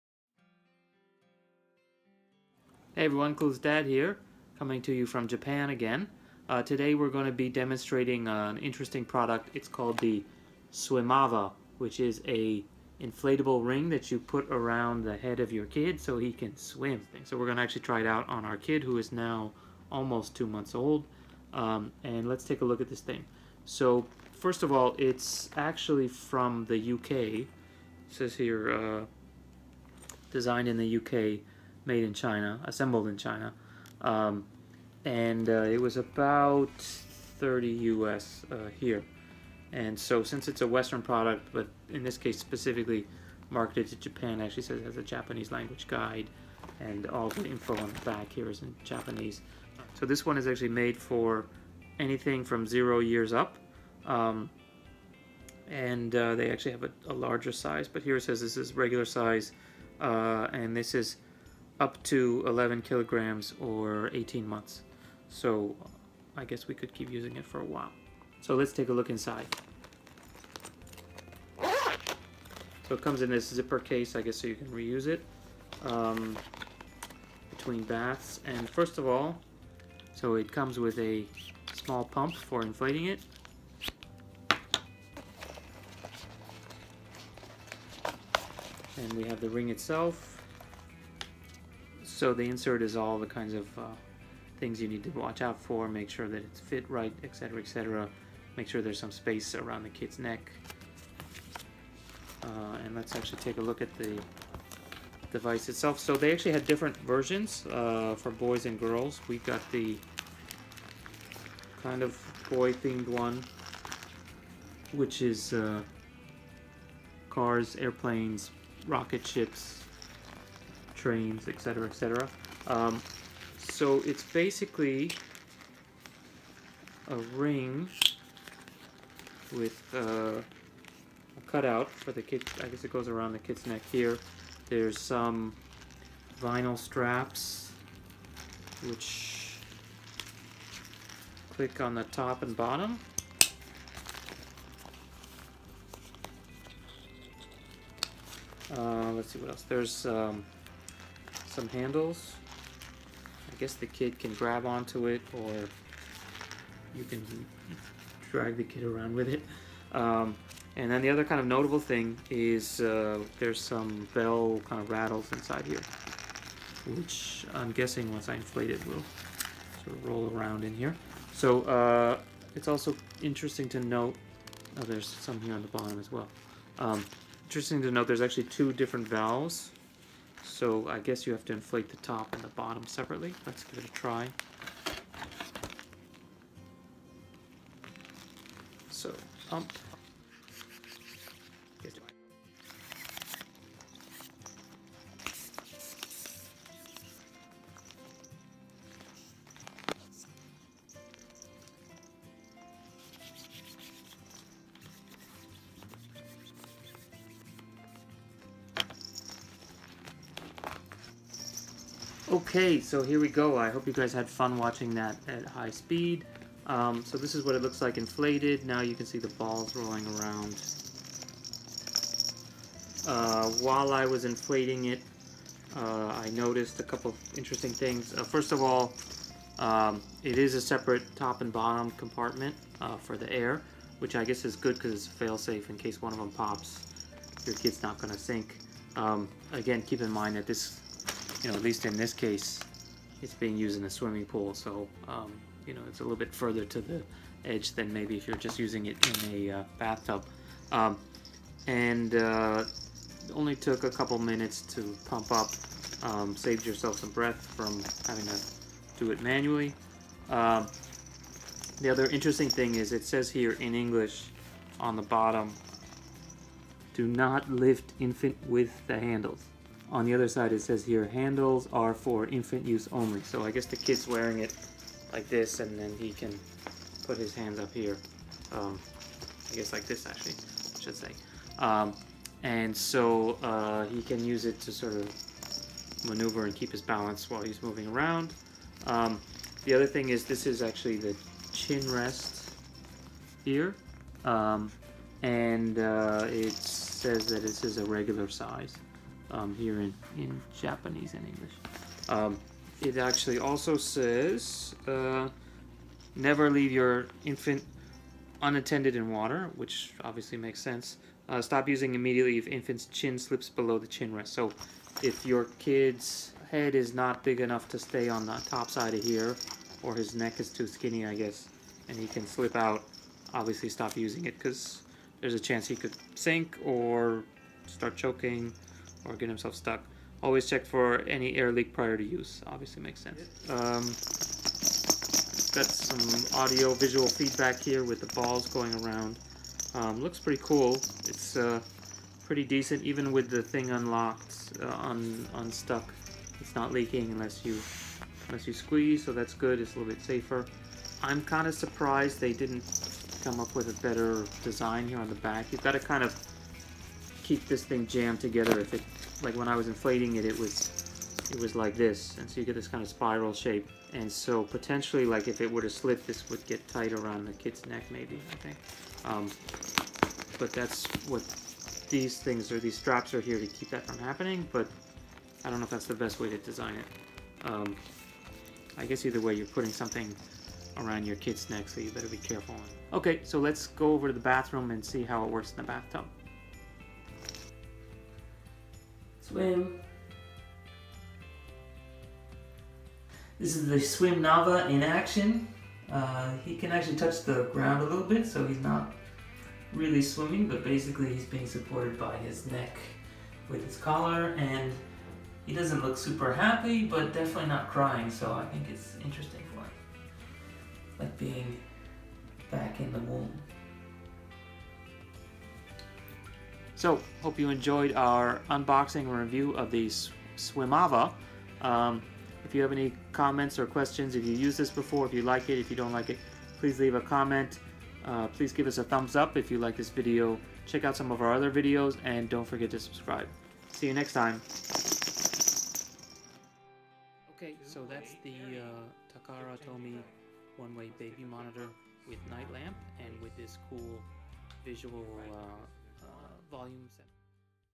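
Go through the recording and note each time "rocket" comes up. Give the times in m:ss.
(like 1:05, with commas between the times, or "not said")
1:58.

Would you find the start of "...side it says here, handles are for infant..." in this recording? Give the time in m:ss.
4:30.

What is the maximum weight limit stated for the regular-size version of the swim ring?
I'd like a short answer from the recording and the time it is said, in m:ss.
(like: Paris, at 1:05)
11 kilograms, at 1:02.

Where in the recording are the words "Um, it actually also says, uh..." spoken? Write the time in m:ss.
5:02.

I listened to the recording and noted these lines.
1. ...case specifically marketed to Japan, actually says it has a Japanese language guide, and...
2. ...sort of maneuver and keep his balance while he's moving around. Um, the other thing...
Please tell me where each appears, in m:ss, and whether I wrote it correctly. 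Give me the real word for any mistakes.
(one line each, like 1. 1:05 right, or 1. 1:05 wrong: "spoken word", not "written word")
1. 0:42 right
2. 4:44 right.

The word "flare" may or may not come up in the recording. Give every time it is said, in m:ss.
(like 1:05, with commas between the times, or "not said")
not said.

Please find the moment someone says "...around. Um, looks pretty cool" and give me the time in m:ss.
5:38.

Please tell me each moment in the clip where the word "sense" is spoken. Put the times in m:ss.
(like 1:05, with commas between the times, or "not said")
5:10, 5:32.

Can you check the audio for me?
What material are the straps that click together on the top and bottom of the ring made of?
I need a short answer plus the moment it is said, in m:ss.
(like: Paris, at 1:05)
vinyl, at 2:16.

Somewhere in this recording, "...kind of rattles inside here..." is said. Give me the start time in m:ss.
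2:44.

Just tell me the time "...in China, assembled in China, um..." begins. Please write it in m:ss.
0:32.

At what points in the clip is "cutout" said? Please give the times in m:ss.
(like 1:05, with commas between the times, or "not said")
2:11.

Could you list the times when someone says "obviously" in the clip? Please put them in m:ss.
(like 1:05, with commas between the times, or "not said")
5:10, 5:23, 5:32.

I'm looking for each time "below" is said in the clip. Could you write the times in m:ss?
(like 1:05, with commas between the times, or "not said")
5:13.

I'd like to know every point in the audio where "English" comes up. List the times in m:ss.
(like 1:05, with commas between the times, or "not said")
4:23, 5:01.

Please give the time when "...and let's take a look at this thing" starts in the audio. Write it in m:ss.
0:22.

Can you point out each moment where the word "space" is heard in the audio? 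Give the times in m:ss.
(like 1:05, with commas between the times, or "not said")
1:39.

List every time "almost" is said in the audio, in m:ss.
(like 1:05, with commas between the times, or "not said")
0:19.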